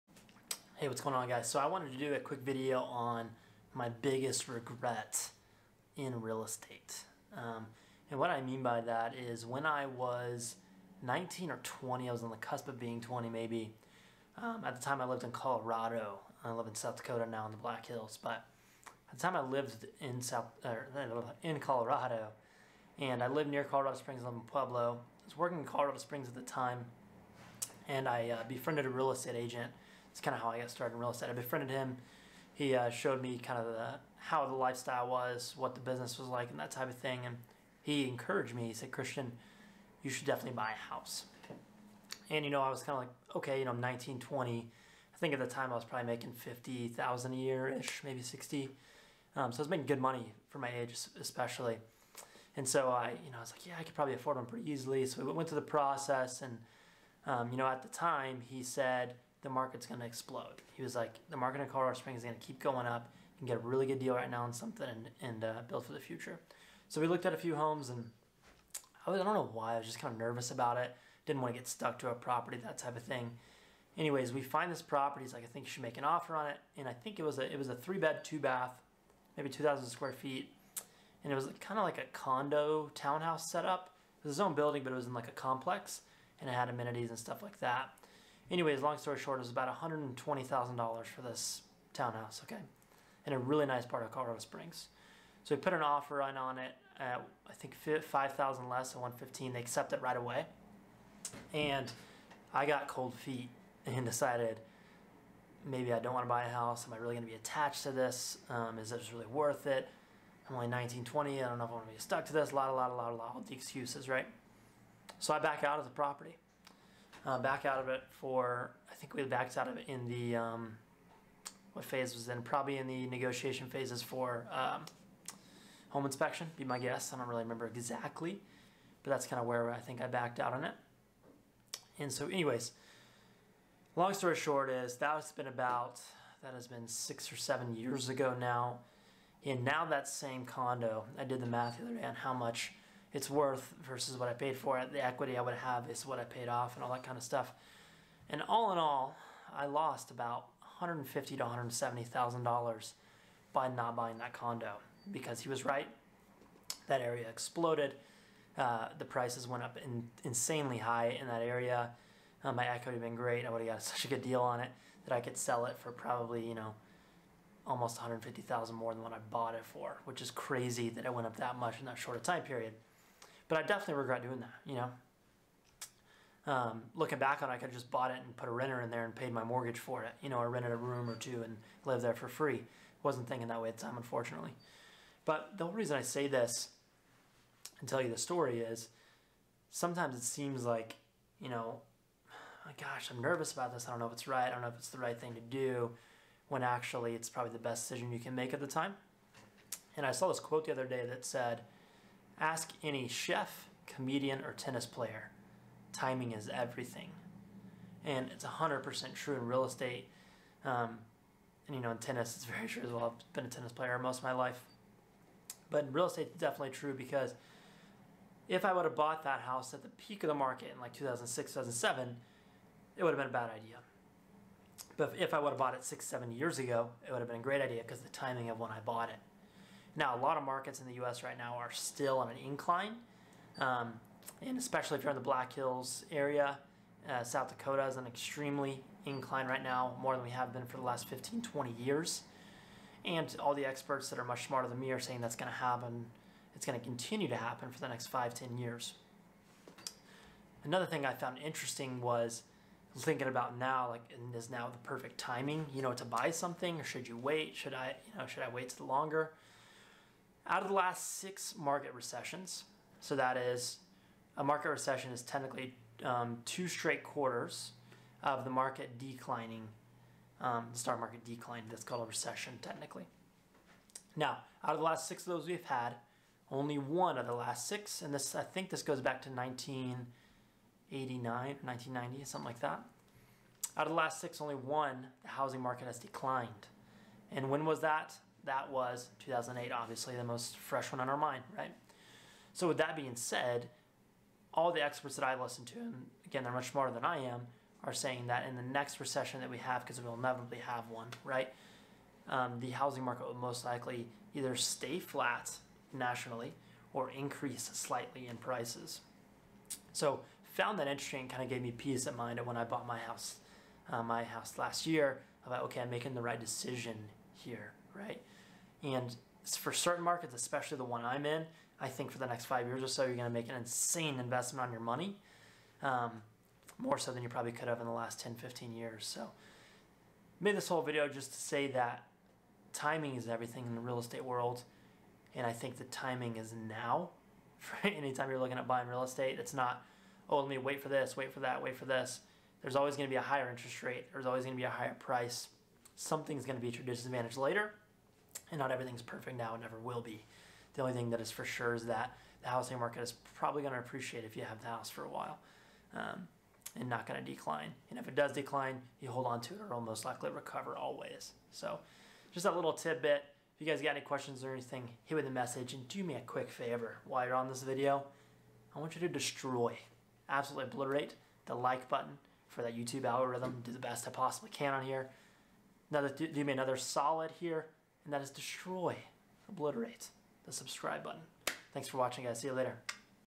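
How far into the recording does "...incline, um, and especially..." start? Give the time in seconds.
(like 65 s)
232 s.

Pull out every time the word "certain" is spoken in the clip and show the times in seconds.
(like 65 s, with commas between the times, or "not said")
319 s.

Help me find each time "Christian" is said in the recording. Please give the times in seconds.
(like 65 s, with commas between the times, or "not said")
38 s.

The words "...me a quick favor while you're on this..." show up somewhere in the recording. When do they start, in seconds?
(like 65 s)
366 s.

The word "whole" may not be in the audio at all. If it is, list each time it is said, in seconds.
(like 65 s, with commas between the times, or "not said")
185 s, 330 s.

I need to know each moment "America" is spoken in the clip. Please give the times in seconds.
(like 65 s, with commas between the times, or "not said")
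not said.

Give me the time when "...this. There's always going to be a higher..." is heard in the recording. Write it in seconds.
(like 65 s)
341 s.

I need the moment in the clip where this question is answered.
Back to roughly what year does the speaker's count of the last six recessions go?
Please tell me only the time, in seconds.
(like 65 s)
279 s.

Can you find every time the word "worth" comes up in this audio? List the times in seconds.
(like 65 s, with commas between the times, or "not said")
109 s, 143 s.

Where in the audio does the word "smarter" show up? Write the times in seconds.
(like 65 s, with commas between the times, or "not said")
244 s, 296 s.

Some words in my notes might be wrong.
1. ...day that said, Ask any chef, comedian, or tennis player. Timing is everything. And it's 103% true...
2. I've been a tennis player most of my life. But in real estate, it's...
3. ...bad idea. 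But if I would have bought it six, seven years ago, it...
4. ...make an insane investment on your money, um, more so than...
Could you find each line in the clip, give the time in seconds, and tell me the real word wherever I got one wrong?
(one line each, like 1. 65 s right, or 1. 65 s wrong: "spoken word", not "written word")
1. 200 s wrong: "100", not "103"
2. 213 s right
3. 223 s right
4. 323 s right.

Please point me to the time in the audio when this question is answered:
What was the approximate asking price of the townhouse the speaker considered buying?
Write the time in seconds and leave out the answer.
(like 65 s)
89 s.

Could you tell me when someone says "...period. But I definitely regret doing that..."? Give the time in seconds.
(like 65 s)
172 s.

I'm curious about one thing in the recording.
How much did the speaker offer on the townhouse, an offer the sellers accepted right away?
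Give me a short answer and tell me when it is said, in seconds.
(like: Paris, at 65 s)
115, at 98 s.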